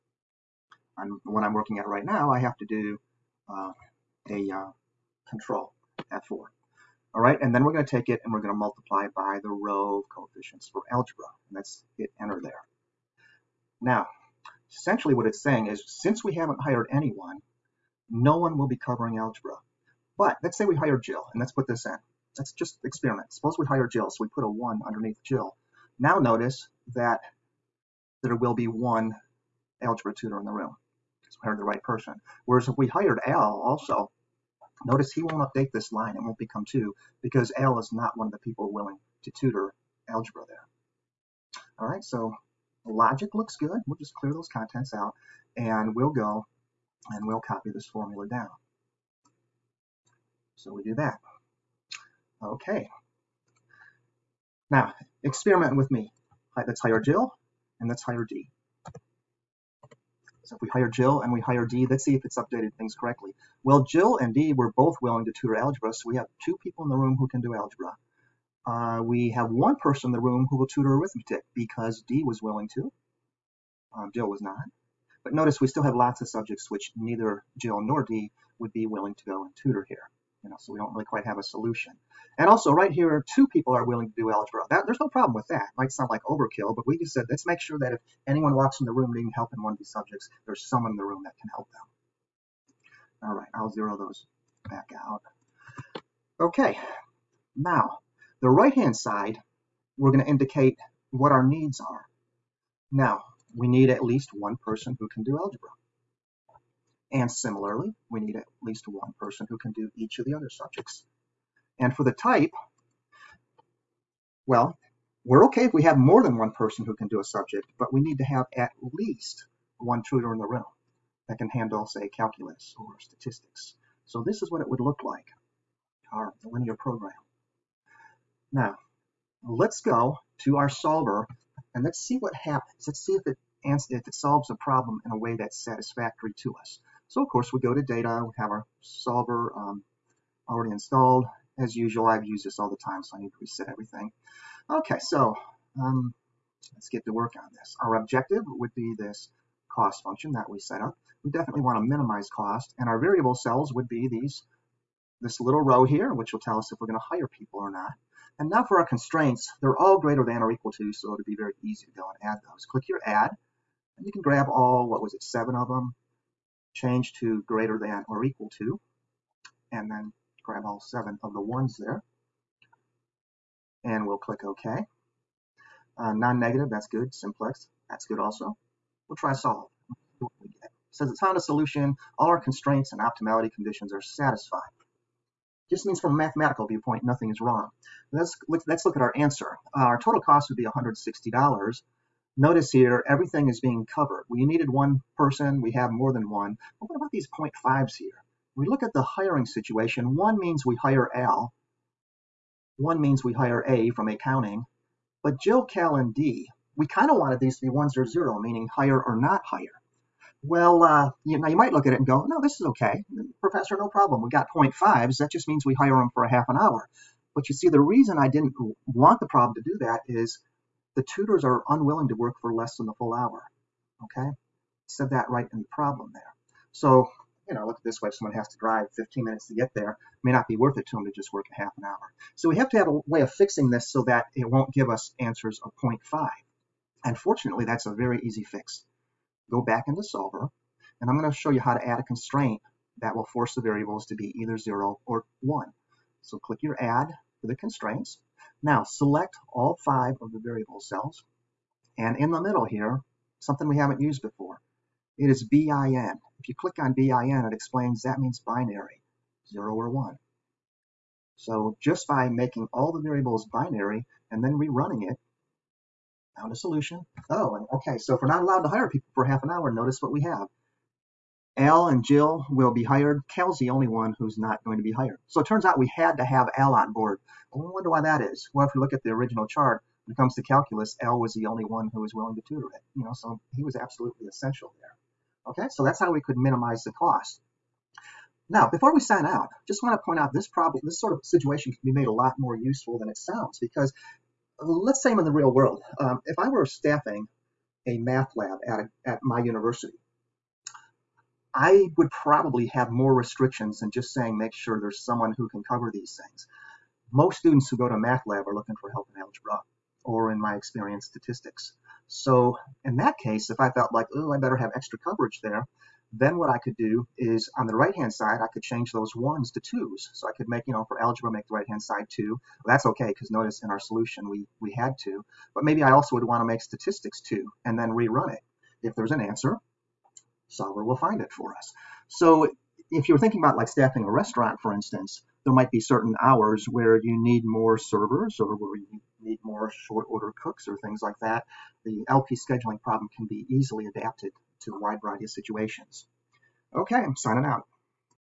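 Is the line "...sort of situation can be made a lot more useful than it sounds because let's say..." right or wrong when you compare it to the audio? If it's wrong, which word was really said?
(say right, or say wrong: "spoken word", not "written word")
right.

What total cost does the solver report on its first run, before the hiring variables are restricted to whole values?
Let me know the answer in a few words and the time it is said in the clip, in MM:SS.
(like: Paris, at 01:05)
$160, at 03:10.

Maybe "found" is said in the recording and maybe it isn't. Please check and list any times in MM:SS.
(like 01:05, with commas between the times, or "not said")
03:01, 04:26.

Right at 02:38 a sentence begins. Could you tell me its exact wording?
And now for our constraints, they're all greater than or equal to, so it'd be very easy to go and add those.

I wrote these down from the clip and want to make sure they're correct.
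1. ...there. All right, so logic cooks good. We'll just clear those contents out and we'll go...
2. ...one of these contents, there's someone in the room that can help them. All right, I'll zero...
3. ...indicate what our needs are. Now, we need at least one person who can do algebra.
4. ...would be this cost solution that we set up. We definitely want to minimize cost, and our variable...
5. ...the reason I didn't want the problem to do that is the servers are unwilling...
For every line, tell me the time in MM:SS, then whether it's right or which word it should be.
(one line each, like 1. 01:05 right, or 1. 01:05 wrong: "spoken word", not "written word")
1. 00:40 wrong: "looks", not "cooks"
2. 01:29 wrong: "subjects", not "contents"
3. 01:40 right
4. 02:28 wrong: "function", not "solution"
5. 03:37 wrong: "tutors", not "servers".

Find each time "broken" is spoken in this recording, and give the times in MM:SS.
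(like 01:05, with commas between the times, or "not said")
not said.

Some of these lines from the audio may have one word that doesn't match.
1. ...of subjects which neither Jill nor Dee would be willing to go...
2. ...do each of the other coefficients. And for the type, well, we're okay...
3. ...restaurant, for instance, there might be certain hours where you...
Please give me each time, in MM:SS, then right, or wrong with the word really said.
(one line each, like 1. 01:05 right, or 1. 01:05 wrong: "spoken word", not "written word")
1. 01:16 right
2. 01:49 wrong: "subjects", not "coefficients"
3. 05:34 right.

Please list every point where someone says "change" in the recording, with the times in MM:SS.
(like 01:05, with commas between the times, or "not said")
02:46, 05:18.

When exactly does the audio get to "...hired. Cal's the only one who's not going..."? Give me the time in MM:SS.
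04:32.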